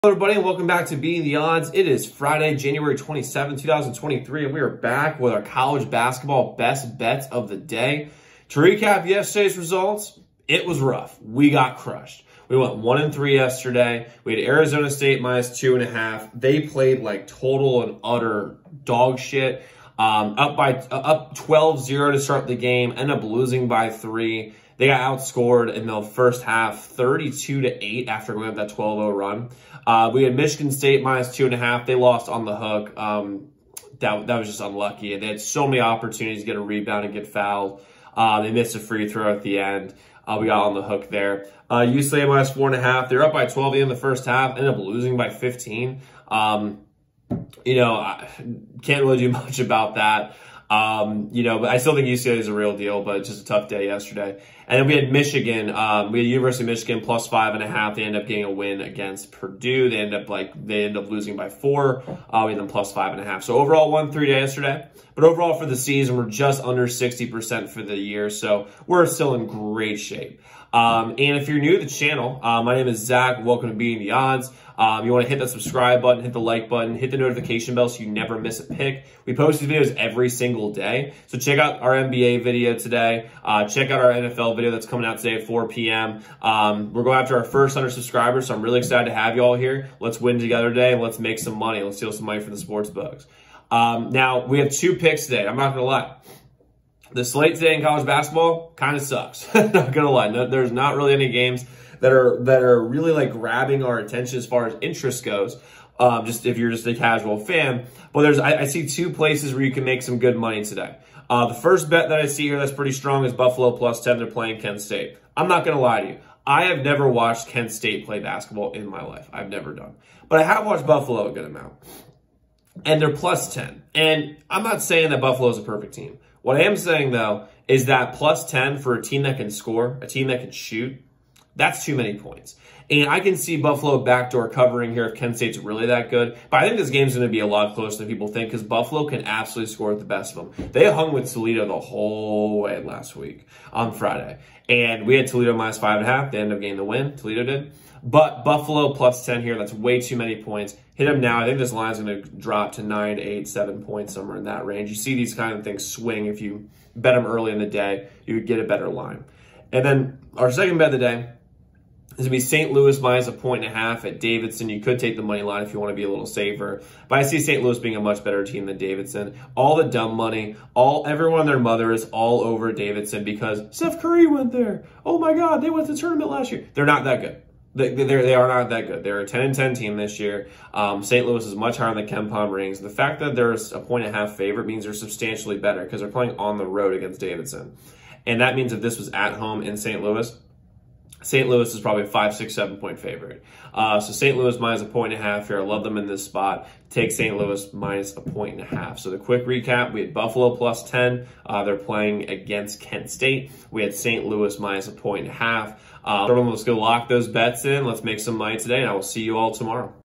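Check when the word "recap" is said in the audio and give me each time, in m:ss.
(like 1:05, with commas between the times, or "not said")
0:08, 3:19.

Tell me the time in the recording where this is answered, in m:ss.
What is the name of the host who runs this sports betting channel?
1:12.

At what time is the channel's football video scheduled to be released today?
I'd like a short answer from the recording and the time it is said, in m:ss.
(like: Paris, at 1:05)
4 p.m., at 1:25.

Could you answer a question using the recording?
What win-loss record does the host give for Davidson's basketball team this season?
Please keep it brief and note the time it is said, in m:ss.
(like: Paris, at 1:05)
10 and 10, at 2:59.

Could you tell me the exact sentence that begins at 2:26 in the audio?
They ended up getting the win.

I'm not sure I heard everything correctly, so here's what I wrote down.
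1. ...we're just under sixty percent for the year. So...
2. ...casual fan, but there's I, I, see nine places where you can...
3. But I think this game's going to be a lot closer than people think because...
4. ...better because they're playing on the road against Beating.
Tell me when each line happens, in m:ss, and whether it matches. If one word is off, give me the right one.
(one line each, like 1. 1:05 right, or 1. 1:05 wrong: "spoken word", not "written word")
1. 1:06 right
2. 1:46 wrong: "two", not "nine"
3. 2:16 right
4. 3:05 wrong: "Davidson", not "Beating".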